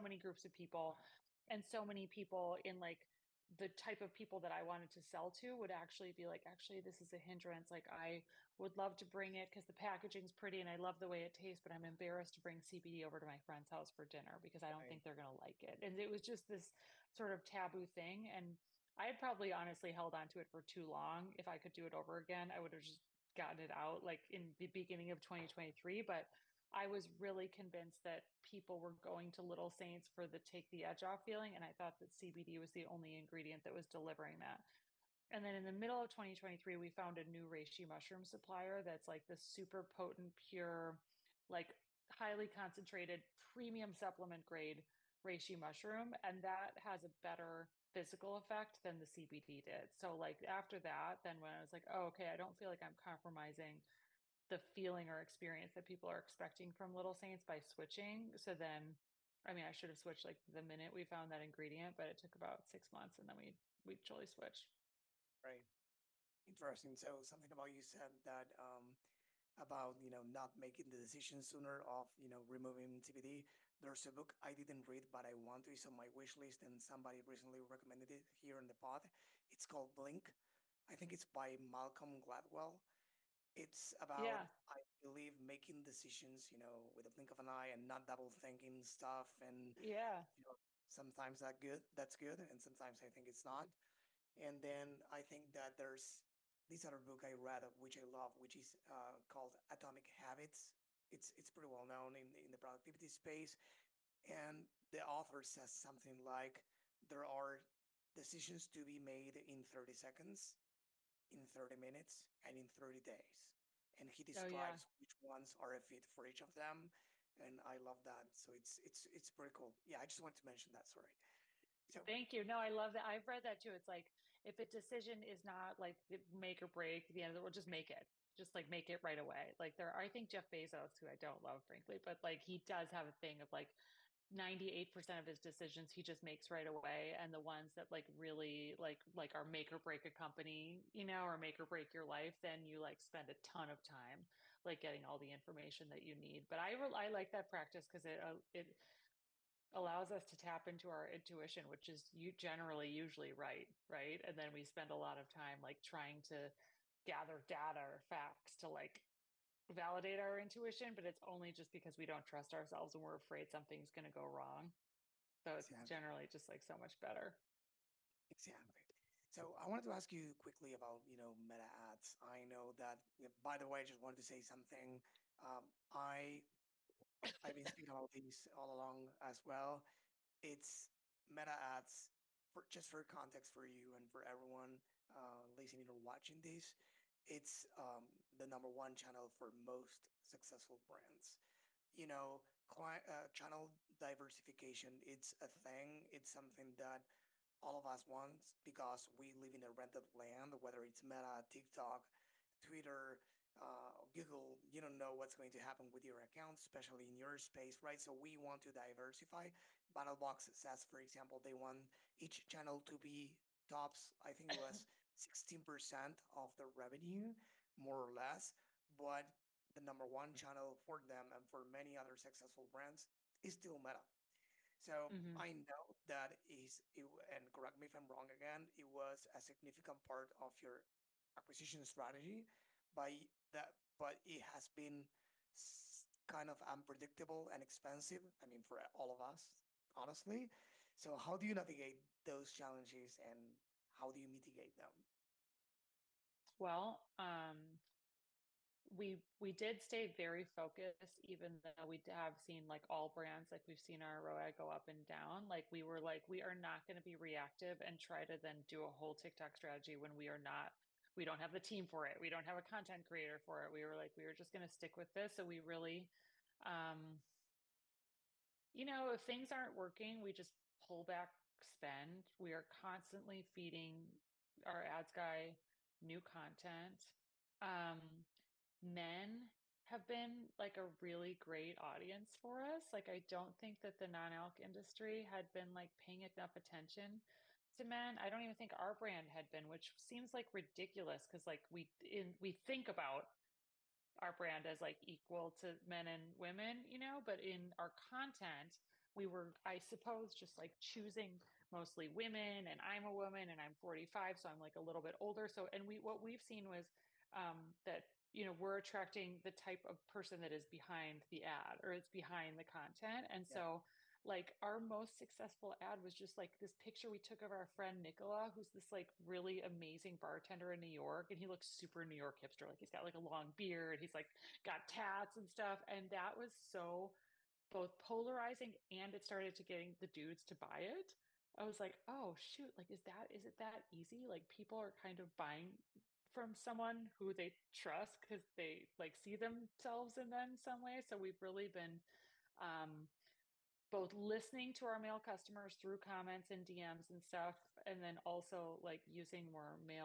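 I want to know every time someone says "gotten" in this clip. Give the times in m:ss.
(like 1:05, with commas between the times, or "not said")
0:23.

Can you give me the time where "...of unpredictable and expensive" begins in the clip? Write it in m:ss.
3:56.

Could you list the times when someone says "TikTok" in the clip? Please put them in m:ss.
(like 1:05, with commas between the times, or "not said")
3:21, 4:19.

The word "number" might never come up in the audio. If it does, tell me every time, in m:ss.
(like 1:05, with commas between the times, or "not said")
3:08, 3:39.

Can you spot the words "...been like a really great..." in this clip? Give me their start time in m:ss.
4:40.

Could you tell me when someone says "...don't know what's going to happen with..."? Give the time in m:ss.
3:24.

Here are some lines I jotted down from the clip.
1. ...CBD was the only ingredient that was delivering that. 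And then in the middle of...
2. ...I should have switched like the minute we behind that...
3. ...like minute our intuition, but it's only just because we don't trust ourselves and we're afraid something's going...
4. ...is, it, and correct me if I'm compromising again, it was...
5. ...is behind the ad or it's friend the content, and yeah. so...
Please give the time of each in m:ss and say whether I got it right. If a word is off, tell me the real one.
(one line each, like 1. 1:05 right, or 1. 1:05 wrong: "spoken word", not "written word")
1. 0:32 right
2. 0:59 wrong: "found", not "behind"
3. 2:38 wrong: "validate", not "minute"
4. 3:46 wrong: "wrong", not "compromising"
5. 5:10 wrong: "behind", not "friend".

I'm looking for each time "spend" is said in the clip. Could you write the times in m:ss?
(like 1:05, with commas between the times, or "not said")
2:22, 2:34, 4:31.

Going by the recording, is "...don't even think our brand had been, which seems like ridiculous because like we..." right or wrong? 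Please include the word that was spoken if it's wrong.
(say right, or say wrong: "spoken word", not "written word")
right.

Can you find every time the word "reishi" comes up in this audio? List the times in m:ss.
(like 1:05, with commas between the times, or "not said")
0:37, 0:45.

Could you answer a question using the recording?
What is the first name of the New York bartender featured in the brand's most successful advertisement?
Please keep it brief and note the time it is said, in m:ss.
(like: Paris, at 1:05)
Nicola, at 5:18.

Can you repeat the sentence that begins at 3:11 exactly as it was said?
You know, client, uh, channel diversification, it's a thing.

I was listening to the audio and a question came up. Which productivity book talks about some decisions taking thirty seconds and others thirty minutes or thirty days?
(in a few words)
Atomic Habits.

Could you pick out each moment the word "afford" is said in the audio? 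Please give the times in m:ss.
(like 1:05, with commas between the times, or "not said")
not said.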